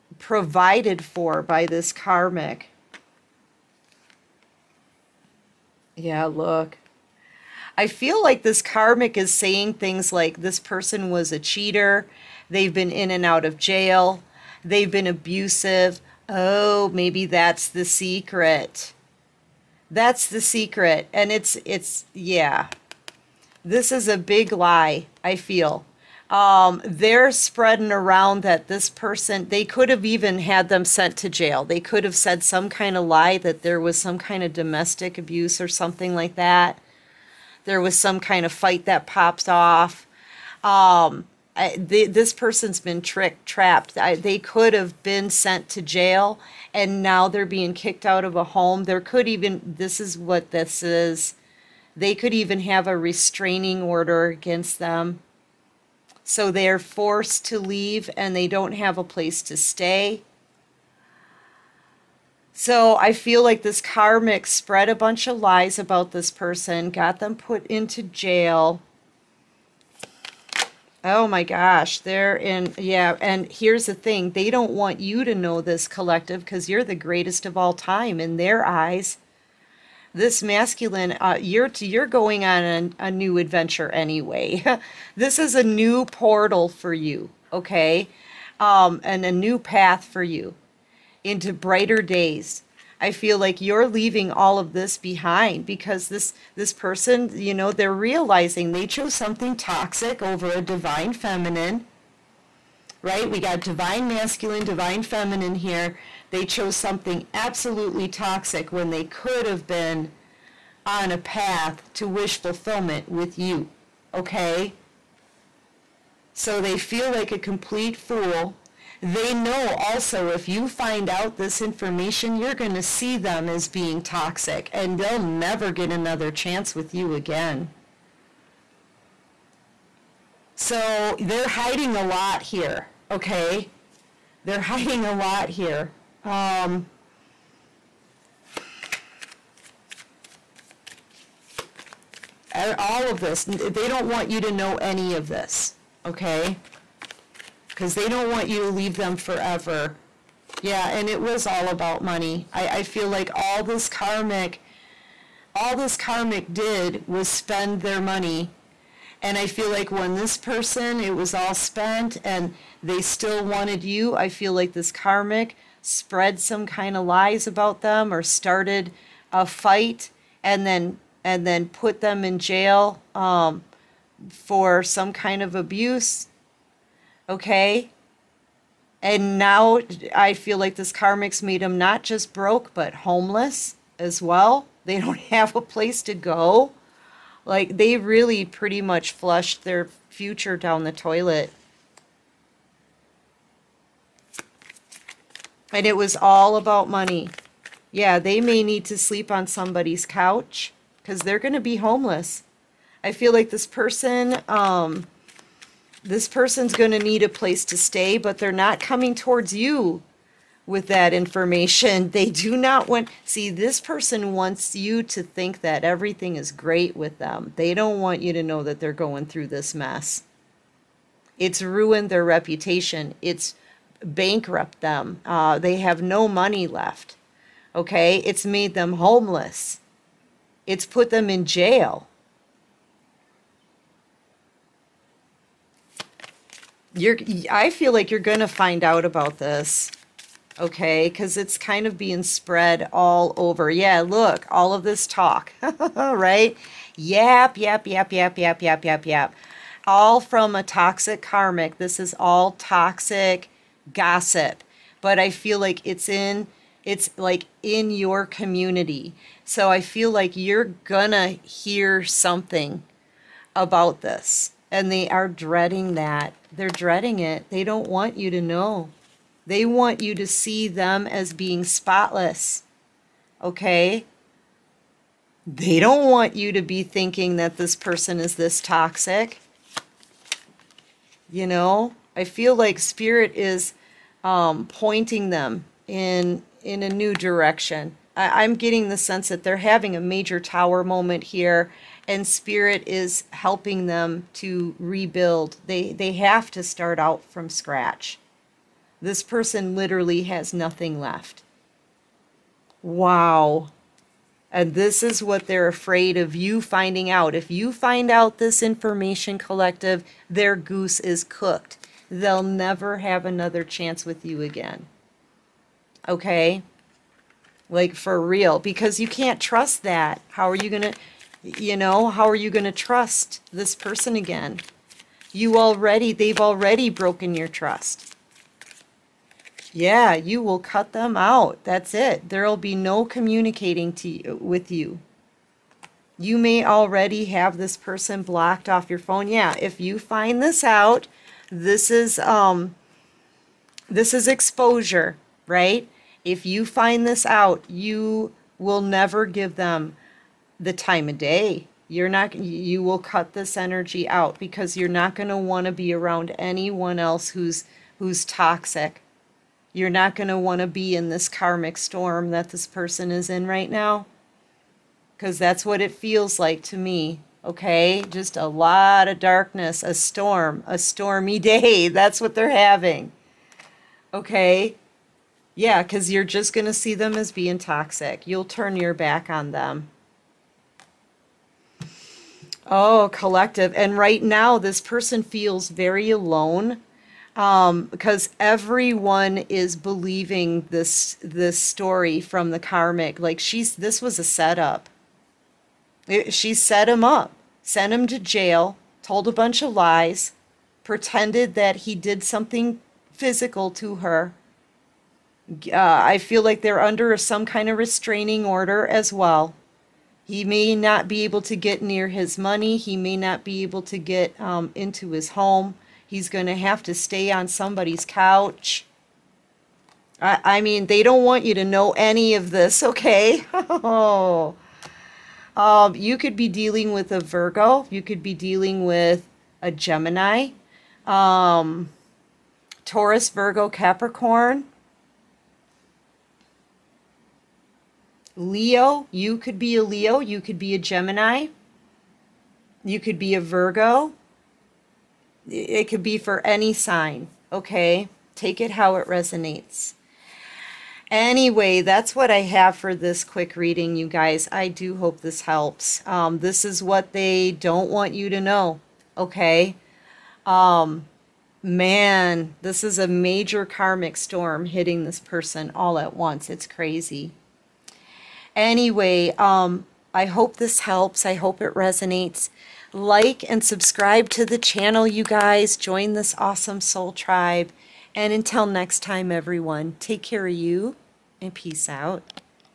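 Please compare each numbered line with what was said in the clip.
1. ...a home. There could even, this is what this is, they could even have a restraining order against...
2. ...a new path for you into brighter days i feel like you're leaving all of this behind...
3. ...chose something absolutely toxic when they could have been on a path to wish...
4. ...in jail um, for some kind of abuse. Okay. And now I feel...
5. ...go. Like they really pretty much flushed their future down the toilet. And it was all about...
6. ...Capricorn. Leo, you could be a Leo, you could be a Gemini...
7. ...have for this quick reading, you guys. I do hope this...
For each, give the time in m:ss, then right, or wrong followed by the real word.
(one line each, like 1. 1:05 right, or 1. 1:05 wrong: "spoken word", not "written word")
1. 0:48 right
2. 1:29 right
3. 1:46 right
4. 2:52 right
5. 3:06 right
6. 7:13 right
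7. 7:32 right.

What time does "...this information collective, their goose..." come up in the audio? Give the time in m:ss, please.
5:08.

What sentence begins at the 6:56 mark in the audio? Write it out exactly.
He's going to have to stay on somebody's couch.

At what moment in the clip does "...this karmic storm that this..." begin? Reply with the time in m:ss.
6:01.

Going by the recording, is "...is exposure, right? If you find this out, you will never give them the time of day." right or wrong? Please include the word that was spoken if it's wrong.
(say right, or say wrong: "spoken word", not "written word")
right.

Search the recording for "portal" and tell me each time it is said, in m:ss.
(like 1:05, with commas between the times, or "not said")
1:26.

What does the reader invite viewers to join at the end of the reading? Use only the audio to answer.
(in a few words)
soul tribe.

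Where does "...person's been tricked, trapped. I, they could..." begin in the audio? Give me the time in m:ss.
0:42.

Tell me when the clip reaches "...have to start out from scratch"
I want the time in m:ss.
4:56.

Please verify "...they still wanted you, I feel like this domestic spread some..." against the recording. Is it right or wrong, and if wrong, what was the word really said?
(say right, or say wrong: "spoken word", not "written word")
wrong: "karmic", not "domestic".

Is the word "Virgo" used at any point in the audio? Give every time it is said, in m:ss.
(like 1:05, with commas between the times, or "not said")
7:07, 7:13, 7:23.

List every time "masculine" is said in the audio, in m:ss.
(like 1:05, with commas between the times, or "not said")
1:20, 1:44.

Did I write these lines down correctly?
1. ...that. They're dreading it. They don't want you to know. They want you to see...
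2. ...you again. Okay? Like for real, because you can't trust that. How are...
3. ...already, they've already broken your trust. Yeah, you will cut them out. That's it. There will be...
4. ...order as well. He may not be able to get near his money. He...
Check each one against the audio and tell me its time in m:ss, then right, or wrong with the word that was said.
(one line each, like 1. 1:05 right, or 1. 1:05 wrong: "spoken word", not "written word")
1. 4:25 right
2. 5:14 right
3. 5:25 right
4. 6:48 right.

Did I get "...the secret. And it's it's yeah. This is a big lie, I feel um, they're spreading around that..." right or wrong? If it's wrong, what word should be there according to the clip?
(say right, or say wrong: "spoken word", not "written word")
right.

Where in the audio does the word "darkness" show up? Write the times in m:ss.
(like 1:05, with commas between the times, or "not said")
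6:09.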